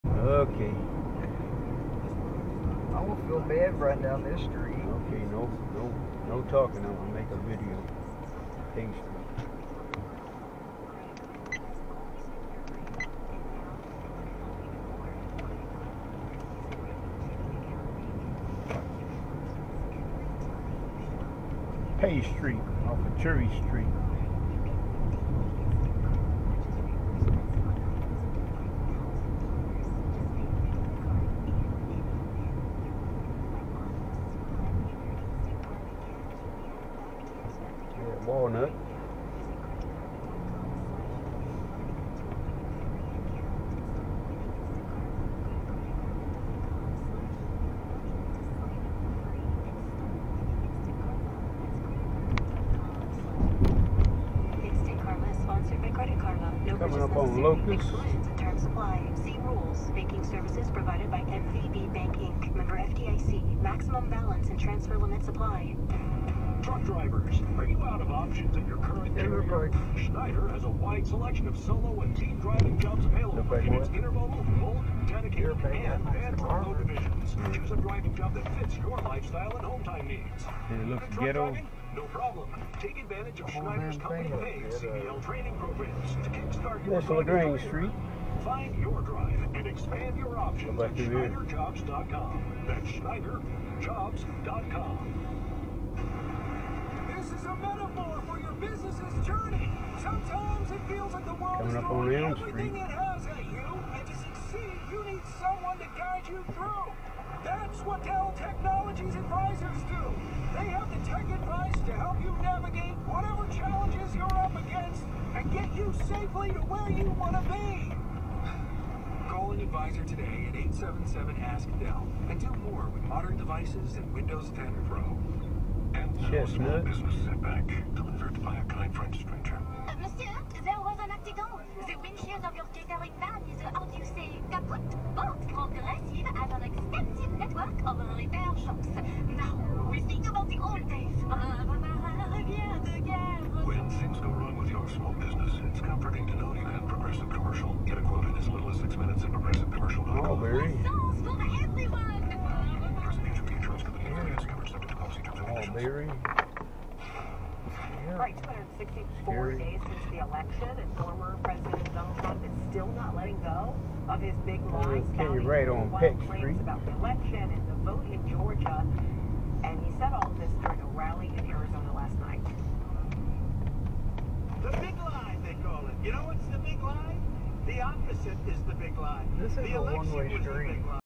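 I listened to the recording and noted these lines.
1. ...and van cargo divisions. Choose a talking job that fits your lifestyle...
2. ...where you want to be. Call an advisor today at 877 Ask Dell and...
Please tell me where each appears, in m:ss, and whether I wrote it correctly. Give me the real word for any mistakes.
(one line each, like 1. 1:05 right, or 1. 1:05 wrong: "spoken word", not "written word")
1. 1:15 wrong: "driving", not "talking"
2. 1:56 right.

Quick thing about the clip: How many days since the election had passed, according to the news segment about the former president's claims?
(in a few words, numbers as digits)
264.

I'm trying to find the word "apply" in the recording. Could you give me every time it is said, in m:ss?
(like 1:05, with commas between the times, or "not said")
0:58, 1:05.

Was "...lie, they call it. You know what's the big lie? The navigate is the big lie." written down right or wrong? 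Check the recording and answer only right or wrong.
wrong.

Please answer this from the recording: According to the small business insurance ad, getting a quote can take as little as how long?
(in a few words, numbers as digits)
6 minutes.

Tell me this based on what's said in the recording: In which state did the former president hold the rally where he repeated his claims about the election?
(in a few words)
Arizona.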